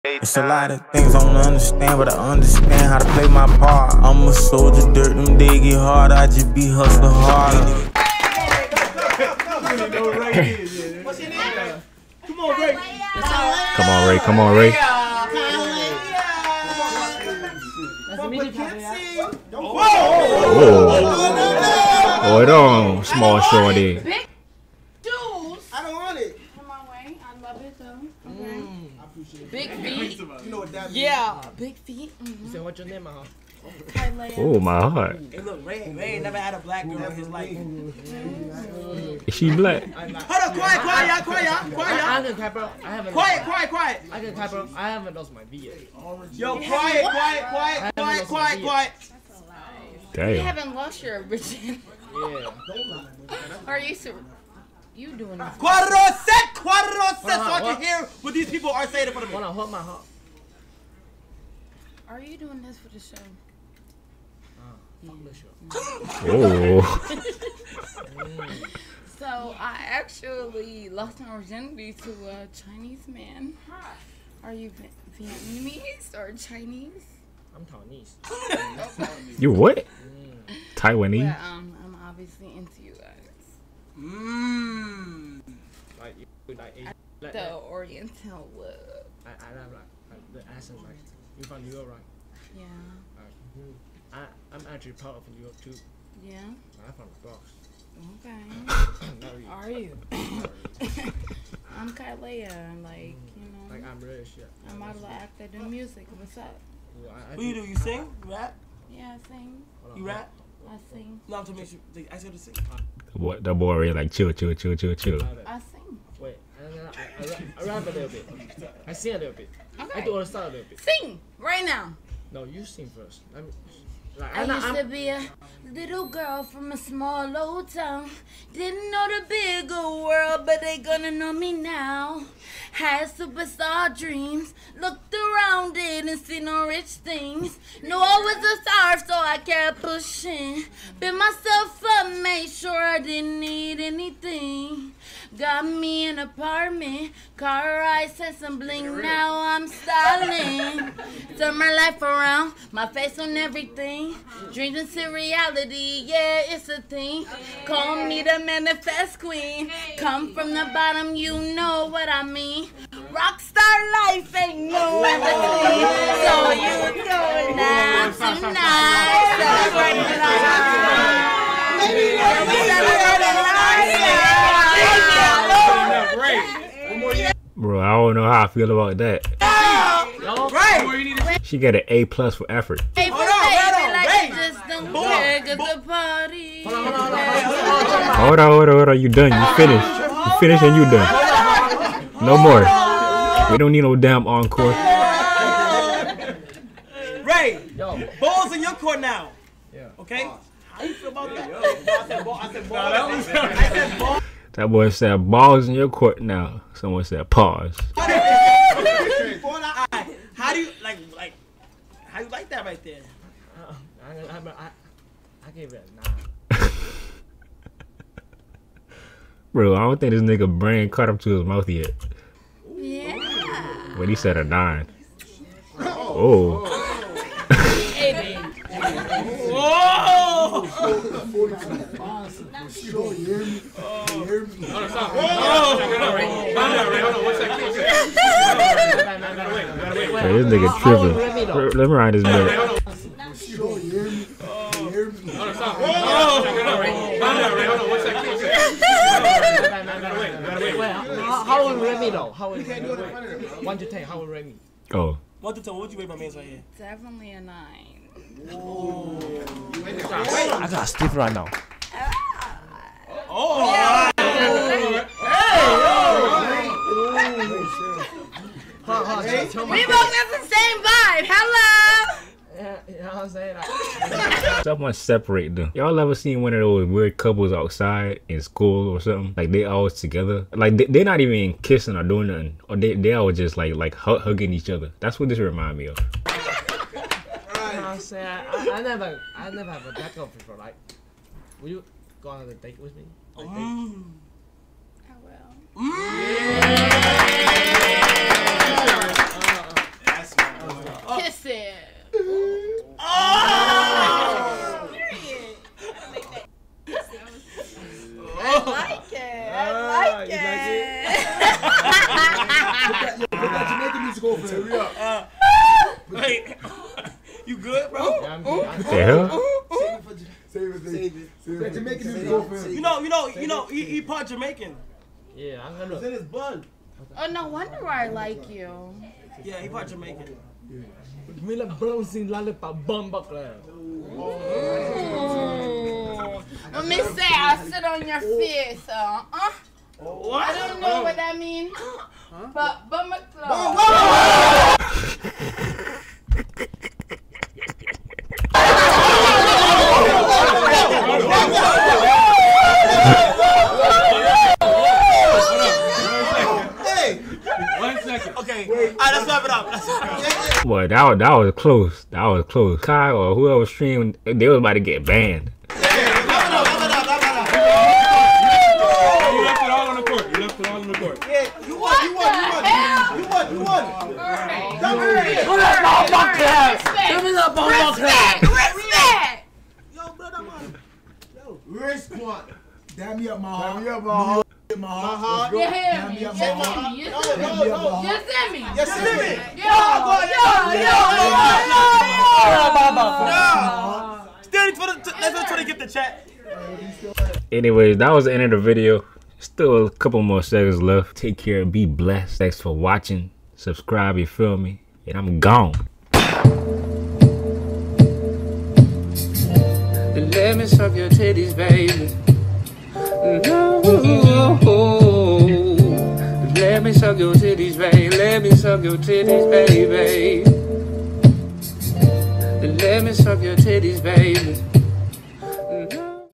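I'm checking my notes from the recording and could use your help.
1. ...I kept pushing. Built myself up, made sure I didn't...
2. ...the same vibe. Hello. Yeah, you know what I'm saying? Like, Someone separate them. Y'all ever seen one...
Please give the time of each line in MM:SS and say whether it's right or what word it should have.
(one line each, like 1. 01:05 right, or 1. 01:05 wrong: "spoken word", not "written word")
1. 02:19 right
2. 04:30 right.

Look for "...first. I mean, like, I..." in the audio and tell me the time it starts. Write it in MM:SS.
02:02.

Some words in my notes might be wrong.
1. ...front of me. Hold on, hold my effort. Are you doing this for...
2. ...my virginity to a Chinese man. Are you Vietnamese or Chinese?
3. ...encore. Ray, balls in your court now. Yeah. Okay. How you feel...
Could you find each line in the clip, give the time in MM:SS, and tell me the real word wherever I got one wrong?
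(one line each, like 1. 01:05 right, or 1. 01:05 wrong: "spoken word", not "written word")
1. 00:59 wrong: "heart", not "effort"
2. 01:11 right
3. 03:14 right.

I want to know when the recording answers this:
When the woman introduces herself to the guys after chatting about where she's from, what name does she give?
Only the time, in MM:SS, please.
01:41.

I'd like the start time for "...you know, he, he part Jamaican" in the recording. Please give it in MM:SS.
05:23.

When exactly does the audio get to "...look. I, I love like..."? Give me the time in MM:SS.
01:28.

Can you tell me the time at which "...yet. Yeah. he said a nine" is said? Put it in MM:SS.
03:41.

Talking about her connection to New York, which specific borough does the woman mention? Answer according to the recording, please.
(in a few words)
The Bronx.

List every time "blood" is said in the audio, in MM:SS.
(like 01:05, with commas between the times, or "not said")
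05:26.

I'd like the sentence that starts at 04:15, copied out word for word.
What would you rate my man's right here?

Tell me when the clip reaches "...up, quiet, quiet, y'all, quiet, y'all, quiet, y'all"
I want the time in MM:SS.
00:40.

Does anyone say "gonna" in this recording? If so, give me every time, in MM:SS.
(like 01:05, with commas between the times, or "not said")
02:10, 05:25.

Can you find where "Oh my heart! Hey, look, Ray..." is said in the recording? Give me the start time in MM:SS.
00:34.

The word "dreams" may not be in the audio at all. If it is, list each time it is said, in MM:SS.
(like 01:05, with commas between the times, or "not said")
02:13, 02:34.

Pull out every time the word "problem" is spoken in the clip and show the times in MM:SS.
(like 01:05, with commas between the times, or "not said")
not said.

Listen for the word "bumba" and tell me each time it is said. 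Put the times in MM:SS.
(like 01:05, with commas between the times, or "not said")
05:32, 05:42.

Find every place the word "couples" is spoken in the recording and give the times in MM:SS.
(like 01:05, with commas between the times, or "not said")
04:37, 06:39.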